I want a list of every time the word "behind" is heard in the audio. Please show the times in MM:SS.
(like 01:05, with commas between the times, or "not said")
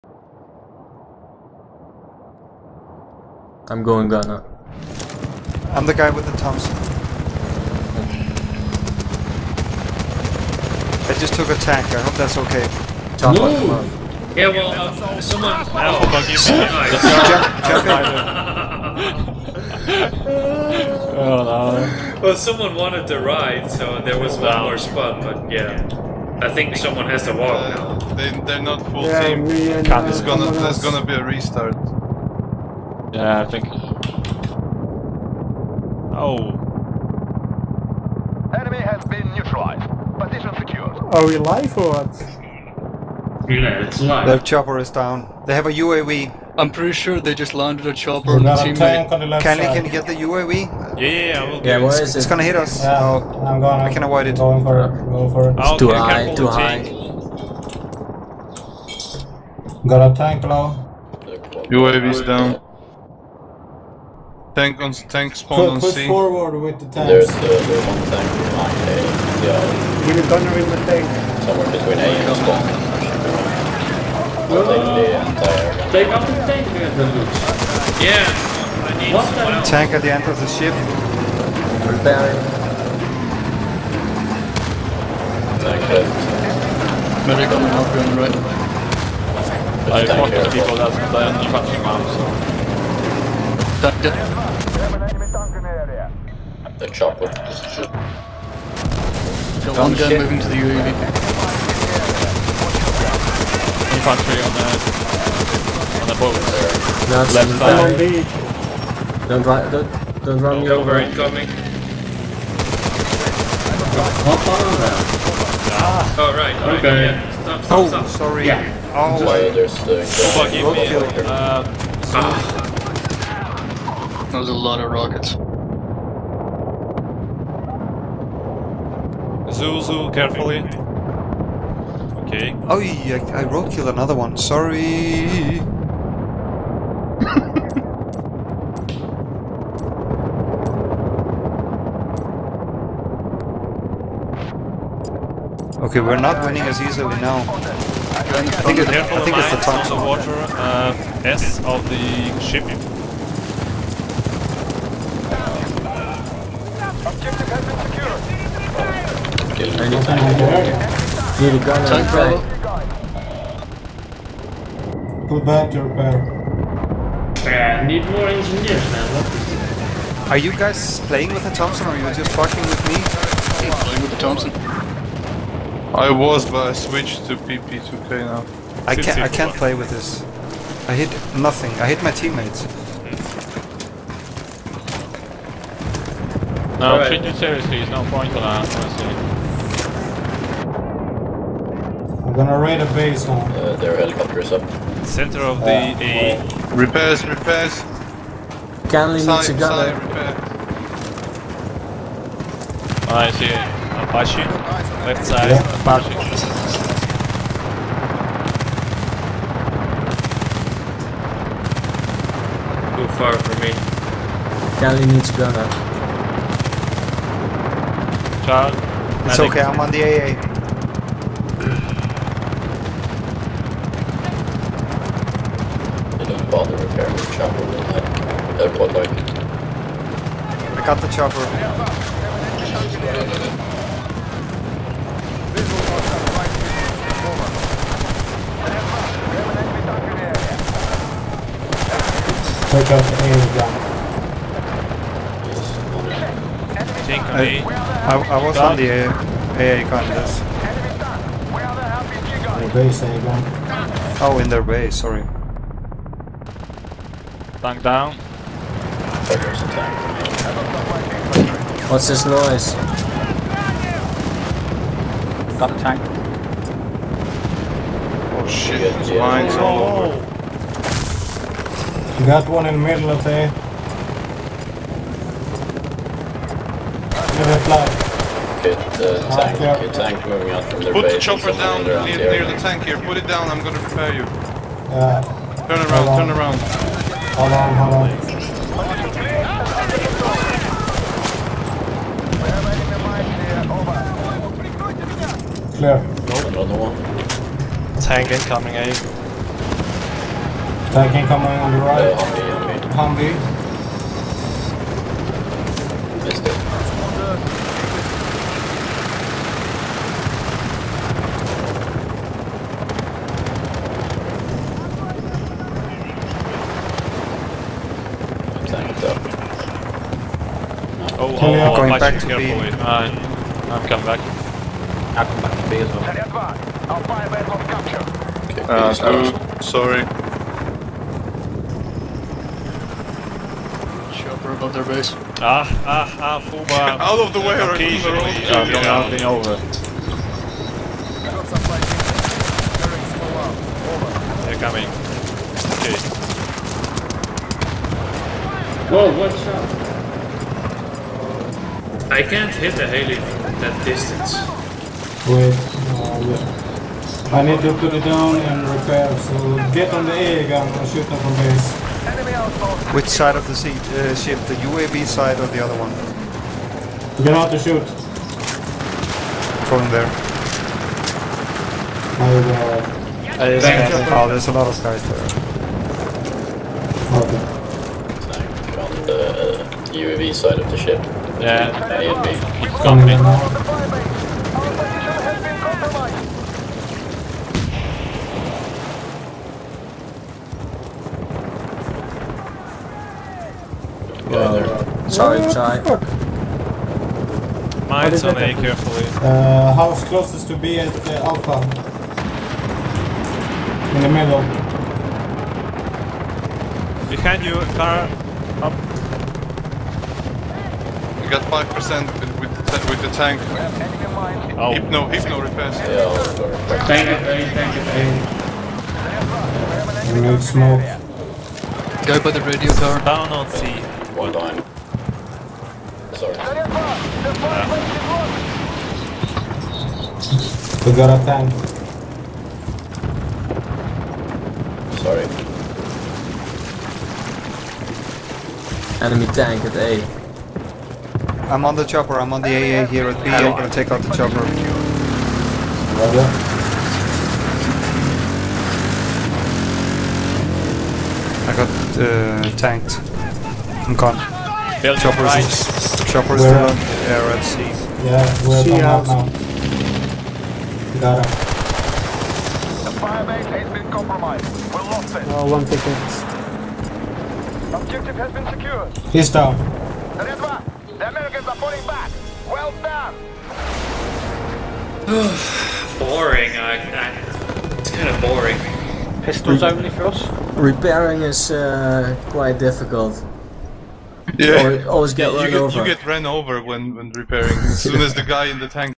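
01:08, 06:47.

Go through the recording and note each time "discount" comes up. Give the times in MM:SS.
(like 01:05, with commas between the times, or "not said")
not said.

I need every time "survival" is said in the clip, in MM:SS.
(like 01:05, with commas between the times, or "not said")
not said.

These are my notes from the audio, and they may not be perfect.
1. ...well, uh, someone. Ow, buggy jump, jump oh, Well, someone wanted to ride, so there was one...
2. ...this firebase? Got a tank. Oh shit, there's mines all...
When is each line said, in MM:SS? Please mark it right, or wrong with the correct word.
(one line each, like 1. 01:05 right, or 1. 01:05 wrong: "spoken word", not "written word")
1. 00:14 right
2. 04:22 wrong: "noise", not "firebase".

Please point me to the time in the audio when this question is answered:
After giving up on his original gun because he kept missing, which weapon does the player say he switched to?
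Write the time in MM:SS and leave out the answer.
02:57.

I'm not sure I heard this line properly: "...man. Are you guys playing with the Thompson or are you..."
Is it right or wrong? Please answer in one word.
right.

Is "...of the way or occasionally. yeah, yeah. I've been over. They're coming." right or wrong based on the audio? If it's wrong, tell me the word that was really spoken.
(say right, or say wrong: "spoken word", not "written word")
right.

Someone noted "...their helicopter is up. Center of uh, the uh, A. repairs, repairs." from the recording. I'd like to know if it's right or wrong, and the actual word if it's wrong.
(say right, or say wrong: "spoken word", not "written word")
right.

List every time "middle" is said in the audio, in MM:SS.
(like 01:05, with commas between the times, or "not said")
04:32, 06:44.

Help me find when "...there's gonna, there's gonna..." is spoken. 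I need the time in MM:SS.
00:30.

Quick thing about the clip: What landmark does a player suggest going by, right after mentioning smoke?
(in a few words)
radio tower.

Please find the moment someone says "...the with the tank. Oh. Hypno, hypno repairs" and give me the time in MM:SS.
06:52.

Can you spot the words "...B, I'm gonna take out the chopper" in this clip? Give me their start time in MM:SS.
07:23.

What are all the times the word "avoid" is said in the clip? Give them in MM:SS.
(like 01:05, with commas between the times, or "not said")
00:54.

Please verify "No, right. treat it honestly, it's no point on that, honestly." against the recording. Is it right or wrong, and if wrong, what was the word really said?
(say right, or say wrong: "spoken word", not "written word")
wrong: "seriously", not "honestly".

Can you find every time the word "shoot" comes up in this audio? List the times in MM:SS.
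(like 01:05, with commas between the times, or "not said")
06:00, 06:07.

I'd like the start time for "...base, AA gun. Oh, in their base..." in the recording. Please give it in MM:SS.
04:12.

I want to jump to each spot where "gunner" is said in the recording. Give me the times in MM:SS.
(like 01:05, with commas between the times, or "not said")
01:10, 03:35.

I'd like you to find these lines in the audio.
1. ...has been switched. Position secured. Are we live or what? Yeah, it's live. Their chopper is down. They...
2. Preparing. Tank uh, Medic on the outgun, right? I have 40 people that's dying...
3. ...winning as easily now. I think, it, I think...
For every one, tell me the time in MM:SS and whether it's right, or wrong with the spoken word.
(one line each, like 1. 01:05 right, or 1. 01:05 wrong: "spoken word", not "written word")
1. 00:38 wrong: "neutralized", not "switched"
2. 01:21 right
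3. 02:26 right.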